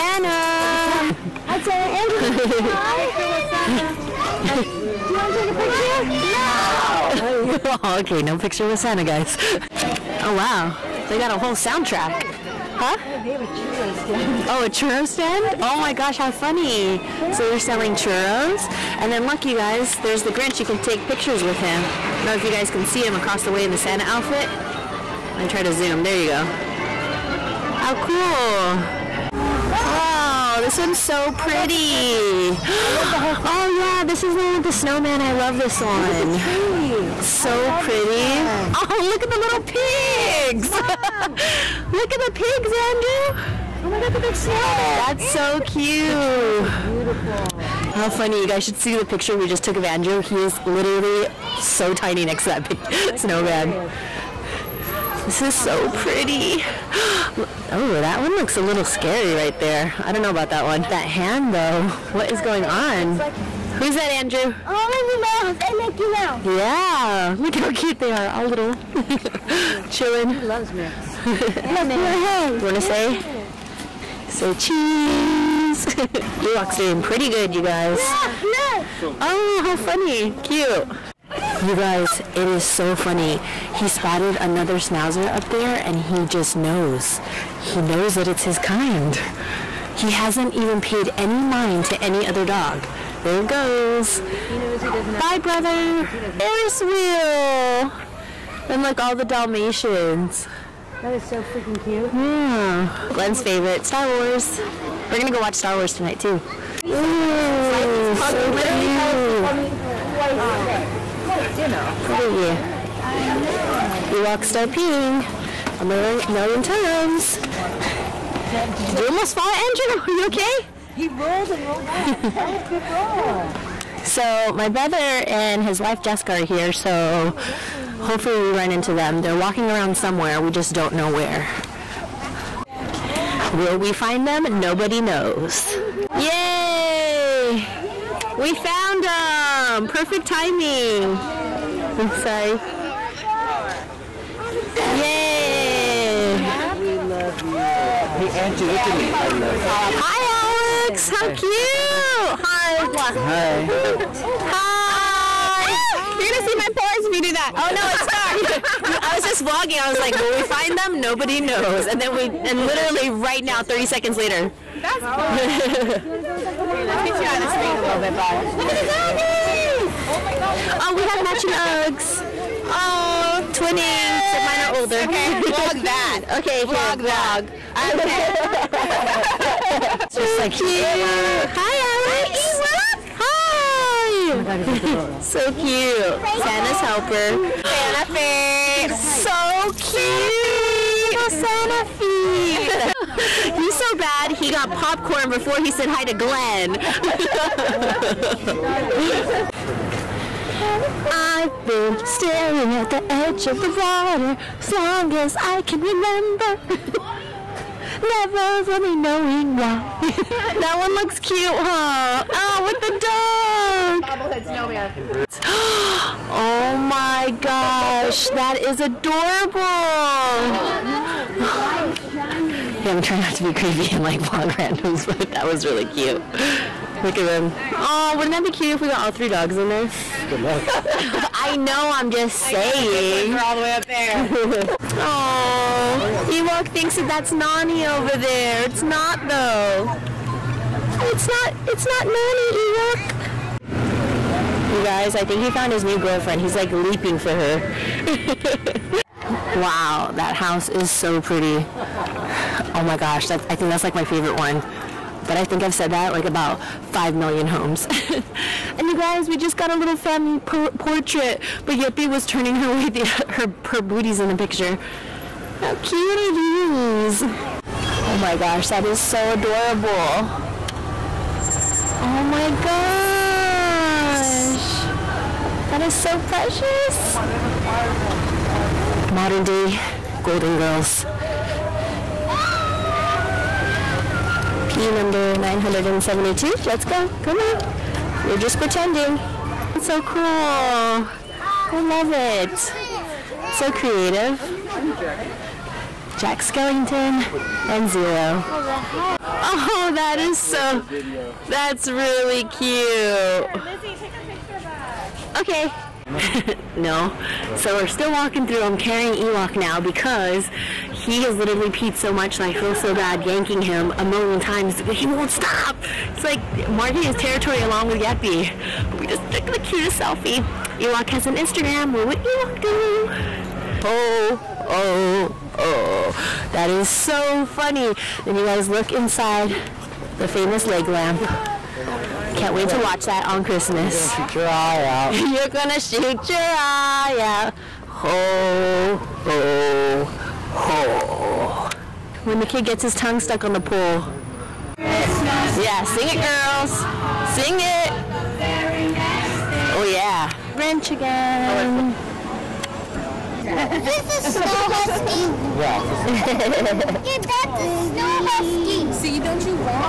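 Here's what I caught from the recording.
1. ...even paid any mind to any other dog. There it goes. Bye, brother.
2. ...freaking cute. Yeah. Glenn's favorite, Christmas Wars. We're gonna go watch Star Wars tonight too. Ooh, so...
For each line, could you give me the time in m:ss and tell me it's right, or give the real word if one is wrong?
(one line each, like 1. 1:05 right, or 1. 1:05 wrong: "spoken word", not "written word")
1. 1:30 right
2. 1:41 wrong: "Star", not "Christmas".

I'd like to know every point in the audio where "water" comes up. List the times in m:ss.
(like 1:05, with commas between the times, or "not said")
3:23.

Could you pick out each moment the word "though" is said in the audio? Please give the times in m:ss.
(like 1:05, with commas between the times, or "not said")
1:01, 3:59.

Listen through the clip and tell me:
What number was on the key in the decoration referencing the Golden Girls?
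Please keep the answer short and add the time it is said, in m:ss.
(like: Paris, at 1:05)
972, at 4:45.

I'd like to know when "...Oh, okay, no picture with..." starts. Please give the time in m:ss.
0:07.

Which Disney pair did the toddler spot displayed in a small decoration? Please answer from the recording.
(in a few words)
Minnie Mouse and Mickey Mouse.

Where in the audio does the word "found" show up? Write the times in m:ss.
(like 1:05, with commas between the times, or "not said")
2:18, 4:05.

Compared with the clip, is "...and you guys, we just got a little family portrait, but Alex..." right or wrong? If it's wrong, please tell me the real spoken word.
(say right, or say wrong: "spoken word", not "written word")
wrong: "Yippee", not "Alex".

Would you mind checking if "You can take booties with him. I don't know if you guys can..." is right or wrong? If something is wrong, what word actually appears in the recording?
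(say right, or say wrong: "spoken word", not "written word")
wrong: "pictures", not "booties".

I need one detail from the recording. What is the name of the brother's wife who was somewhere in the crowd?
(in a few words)
Jessica.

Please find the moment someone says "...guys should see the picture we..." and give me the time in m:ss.
0:48.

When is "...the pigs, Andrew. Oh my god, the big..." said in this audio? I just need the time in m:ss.
0:42.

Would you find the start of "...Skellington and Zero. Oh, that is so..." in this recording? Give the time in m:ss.
4:56.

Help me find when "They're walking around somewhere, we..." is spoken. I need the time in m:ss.
2:09.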